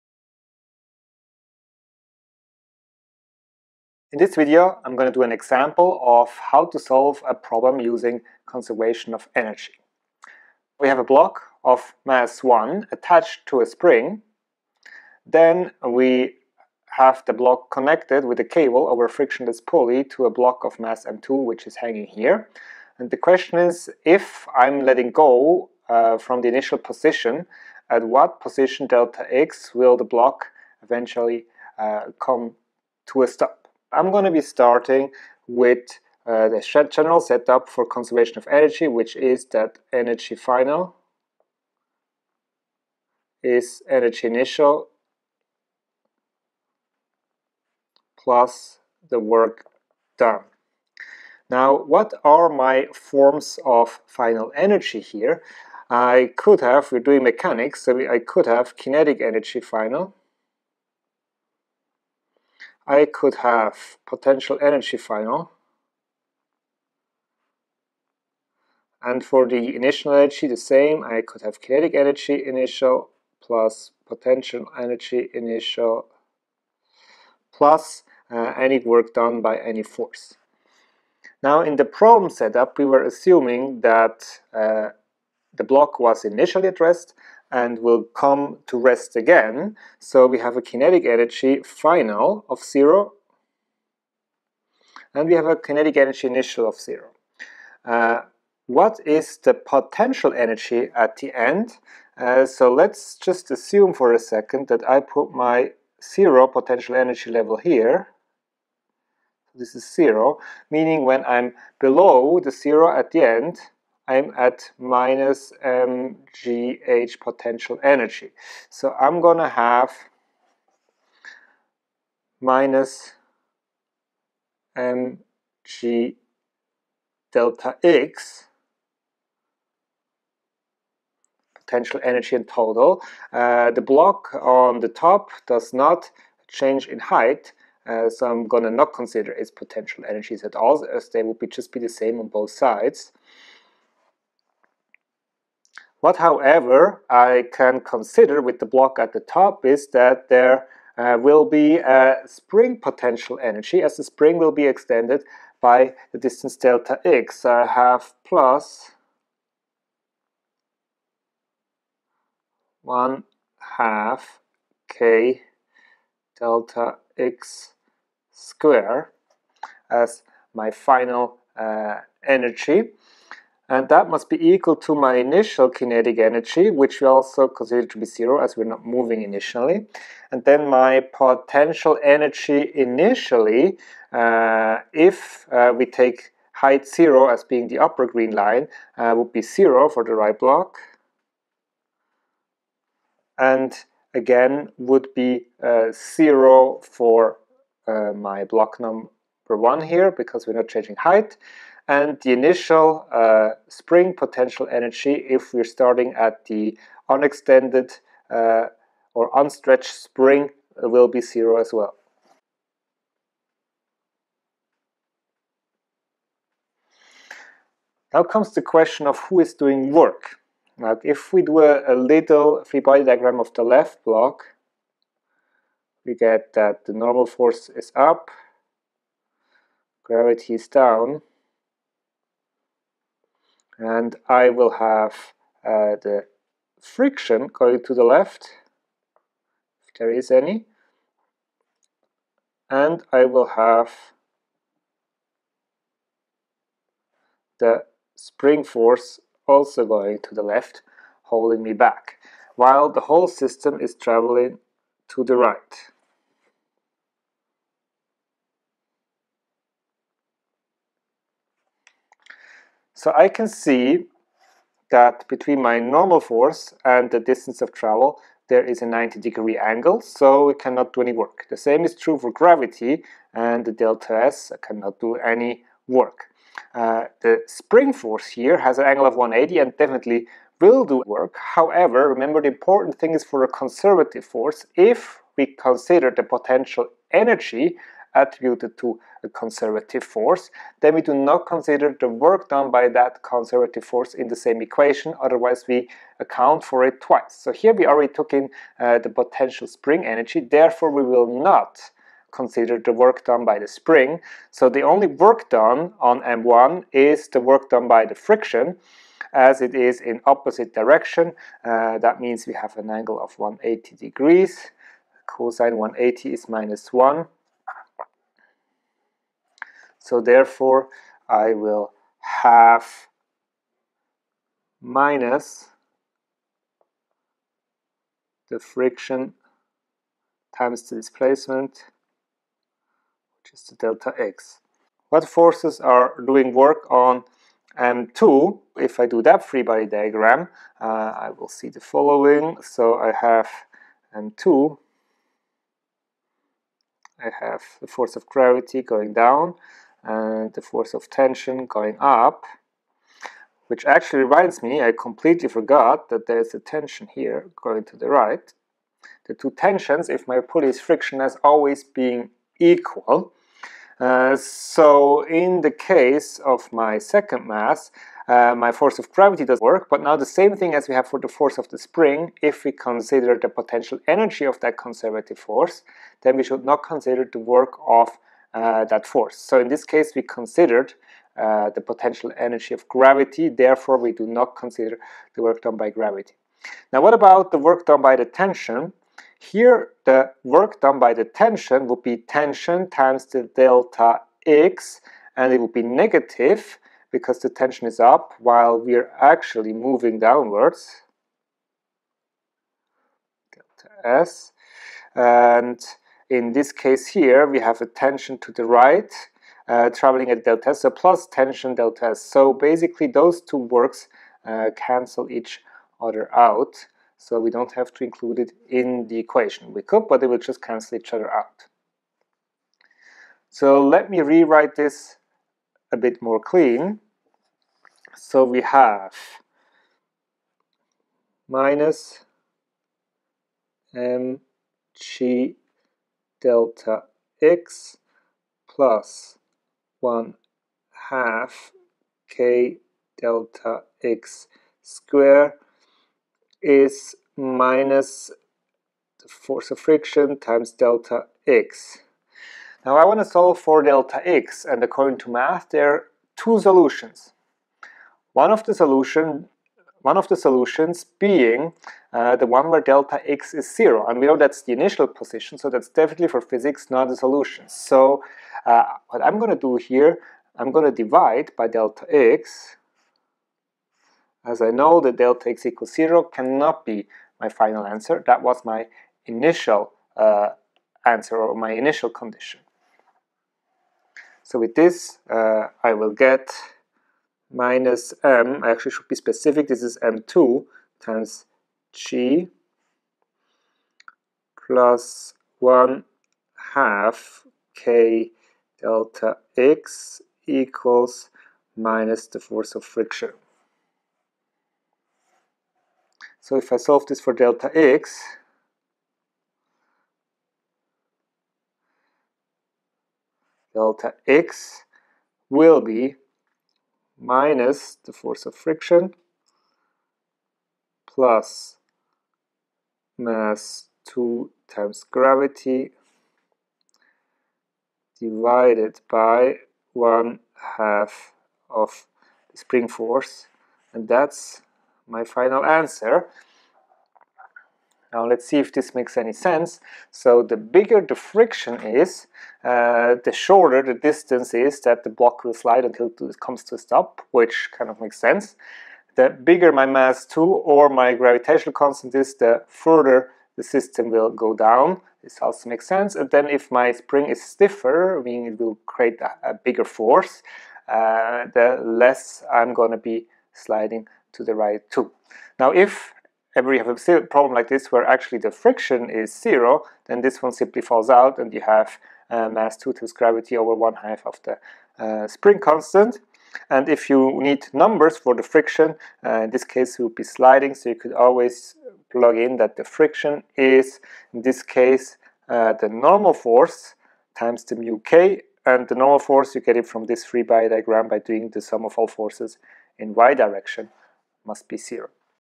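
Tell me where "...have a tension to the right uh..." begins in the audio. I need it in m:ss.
6:47.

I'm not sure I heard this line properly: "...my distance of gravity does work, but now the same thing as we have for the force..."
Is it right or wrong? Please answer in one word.
wrong.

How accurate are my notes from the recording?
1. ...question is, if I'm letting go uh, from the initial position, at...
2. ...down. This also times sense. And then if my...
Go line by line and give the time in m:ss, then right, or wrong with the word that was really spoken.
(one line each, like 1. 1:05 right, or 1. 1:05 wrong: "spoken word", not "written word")
1. 0:23 right
2. 9:14 wrong: "makes", not "times".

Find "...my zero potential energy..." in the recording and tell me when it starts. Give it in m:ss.
1:45.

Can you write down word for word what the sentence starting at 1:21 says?
Now in the problem setup we were assuming that uh, the block was initially addressed and will come to rest again.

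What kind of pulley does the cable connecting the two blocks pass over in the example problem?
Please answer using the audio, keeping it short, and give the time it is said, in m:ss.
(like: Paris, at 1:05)
Frictionless pulley, at 0:19.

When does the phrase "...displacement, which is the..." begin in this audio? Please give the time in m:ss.
5:30.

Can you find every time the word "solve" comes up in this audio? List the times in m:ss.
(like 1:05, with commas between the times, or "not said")
0:06, 7:33, 8:26.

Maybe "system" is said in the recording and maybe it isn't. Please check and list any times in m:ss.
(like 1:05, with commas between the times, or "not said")
4:13, 9:13.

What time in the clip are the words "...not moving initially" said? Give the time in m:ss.
2:58.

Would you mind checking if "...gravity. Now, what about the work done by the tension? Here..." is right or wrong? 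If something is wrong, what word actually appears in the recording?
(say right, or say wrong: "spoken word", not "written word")
right.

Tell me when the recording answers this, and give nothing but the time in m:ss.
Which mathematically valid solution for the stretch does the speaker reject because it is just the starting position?
7:42.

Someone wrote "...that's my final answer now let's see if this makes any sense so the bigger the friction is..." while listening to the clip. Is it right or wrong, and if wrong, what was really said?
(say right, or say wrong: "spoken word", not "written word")
right.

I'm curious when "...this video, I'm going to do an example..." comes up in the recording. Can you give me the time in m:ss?
0:04.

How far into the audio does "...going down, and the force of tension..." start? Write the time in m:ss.
5:48.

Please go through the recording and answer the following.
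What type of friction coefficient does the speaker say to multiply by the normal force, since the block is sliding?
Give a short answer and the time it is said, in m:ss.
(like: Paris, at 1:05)
mu k, at 9:47.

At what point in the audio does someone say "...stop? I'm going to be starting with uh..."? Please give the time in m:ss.
0:33.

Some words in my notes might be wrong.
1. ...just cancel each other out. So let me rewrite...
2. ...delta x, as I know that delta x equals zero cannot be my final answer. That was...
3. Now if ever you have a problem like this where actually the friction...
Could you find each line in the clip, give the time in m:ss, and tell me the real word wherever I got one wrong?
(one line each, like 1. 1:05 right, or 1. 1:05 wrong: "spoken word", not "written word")
1. 7:00 right
2. 7:51 right
3. 9:25 right.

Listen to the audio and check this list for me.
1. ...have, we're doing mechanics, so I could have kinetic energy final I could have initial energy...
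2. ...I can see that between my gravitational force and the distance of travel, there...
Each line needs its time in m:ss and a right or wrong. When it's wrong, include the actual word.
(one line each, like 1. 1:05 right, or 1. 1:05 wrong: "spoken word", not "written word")
1. 0:56 wrong: "potential", not "initial"
2. 4:23 wrong: "normal", not "gravitational".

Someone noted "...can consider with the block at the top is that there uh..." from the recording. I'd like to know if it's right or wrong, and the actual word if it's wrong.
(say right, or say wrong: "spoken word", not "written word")
right.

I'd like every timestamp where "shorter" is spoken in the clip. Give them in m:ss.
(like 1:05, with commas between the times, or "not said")
9:03.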